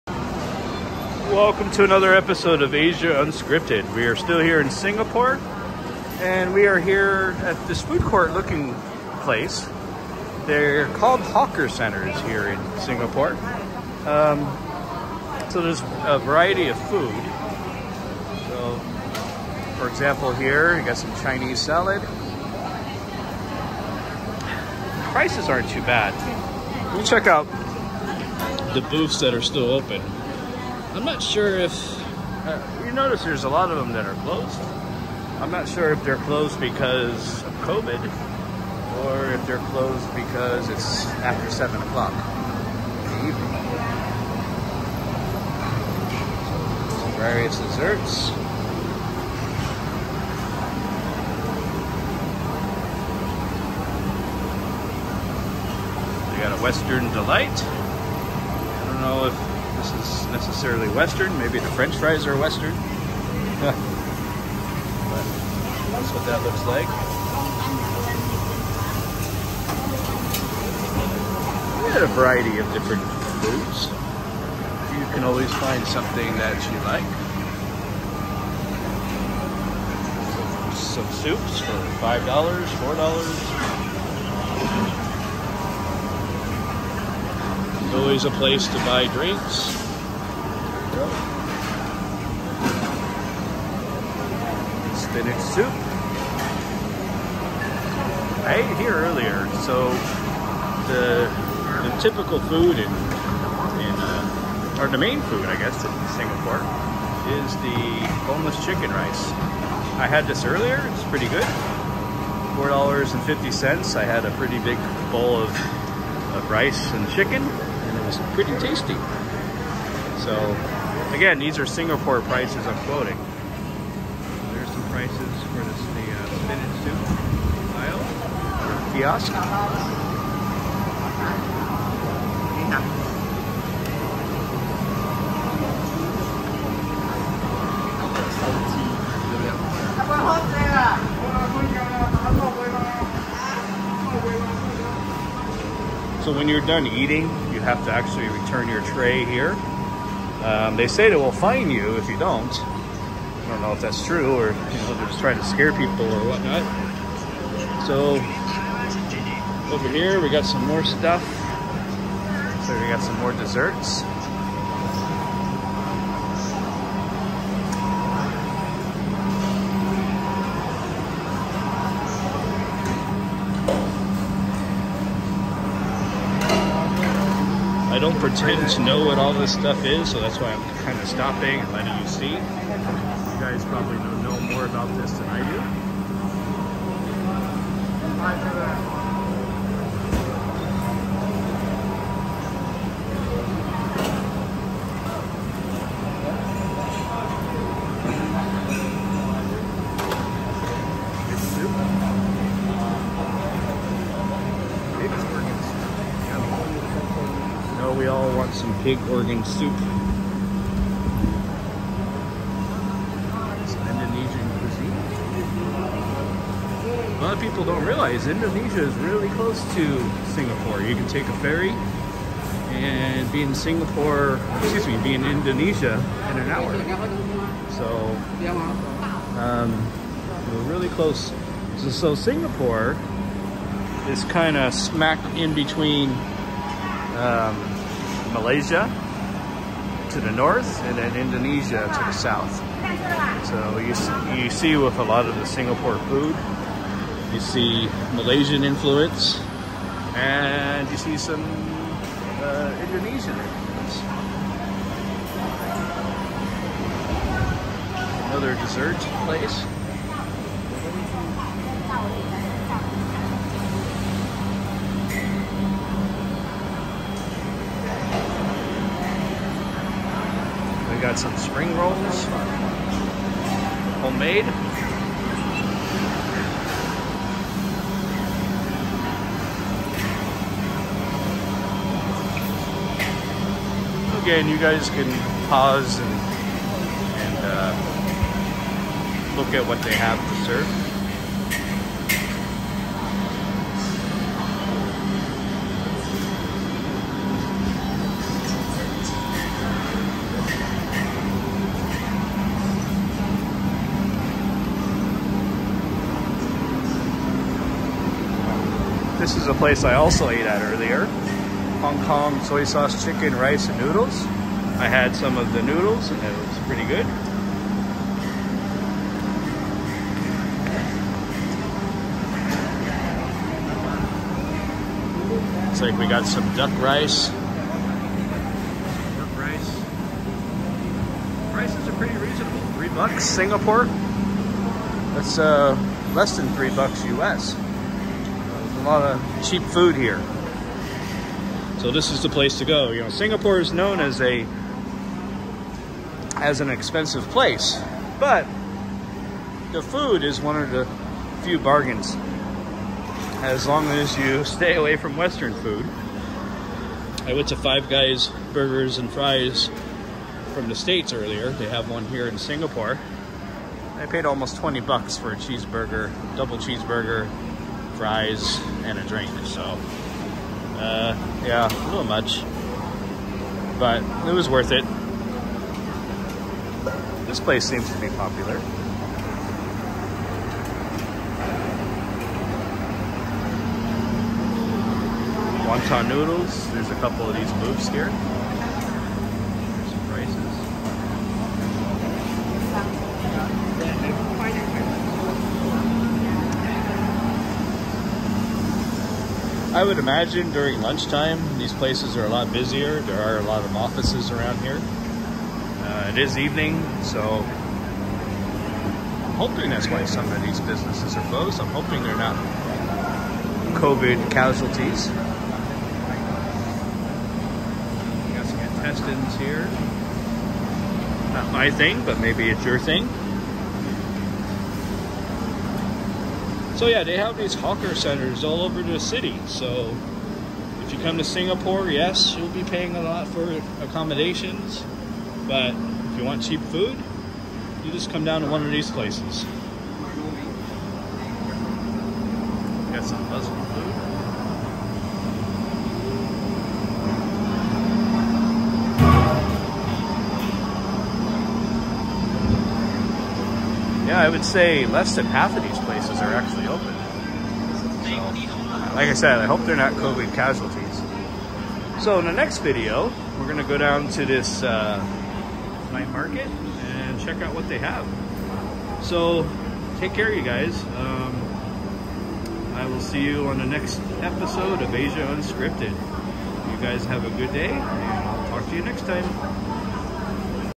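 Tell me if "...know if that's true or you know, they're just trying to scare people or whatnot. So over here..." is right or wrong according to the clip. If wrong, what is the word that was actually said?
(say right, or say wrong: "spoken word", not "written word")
right.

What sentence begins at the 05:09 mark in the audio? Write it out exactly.
This is a place I also ate at earlier.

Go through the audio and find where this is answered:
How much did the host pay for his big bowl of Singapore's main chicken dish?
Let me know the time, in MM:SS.
01:52.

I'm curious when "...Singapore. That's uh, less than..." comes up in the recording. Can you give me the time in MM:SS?
05:33.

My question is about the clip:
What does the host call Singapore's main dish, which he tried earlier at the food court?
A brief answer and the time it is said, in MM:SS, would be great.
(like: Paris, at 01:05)
boneless chicken rice, at 01:48.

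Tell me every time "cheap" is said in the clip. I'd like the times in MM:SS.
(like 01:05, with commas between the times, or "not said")
05:39, 07:16.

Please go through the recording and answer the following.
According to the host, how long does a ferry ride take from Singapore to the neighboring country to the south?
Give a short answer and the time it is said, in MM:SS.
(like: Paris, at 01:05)
an hour, at 03:46.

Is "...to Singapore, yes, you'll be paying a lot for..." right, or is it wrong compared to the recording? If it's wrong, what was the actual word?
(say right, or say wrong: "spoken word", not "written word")
right.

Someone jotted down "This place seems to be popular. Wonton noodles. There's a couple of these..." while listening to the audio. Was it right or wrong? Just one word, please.
right.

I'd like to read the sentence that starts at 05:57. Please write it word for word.
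I went to Five Guys Burgers and Fries from the States earlier.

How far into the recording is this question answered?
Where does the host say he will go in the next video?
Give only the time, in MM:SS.
07:45.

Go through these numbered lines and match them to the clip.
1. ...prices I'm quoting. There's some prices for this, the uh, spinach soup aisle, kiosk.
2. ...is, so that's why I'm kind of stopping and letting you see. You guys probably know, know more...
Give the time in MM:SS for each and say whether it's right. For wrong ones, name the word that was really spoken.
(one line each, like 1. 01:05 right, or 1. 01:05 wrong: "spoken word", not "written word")
1. 02:02 right
2. 02:59 right.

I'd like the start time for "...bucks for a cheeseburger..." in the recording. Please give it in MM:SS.
06:04.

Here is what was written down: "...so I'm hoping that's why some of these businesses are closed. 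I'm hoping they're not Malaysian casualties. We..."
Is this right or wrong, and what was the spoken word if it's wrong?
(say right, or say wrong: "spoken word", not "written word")
wrong: "COVID", not "Malaysian".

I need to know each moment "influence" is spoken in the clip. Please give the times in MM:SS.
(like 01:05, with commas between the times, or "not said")
04:08, 04:13.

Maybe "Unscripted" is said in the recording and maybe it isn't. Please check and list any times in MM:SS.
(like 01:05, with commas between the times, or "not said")
00:03, 07:55.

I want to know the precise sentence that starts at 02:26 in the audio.
So when you're done eating, you have to actually return your tray here.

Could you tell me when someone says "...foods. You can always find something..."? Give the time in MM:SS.
01:13.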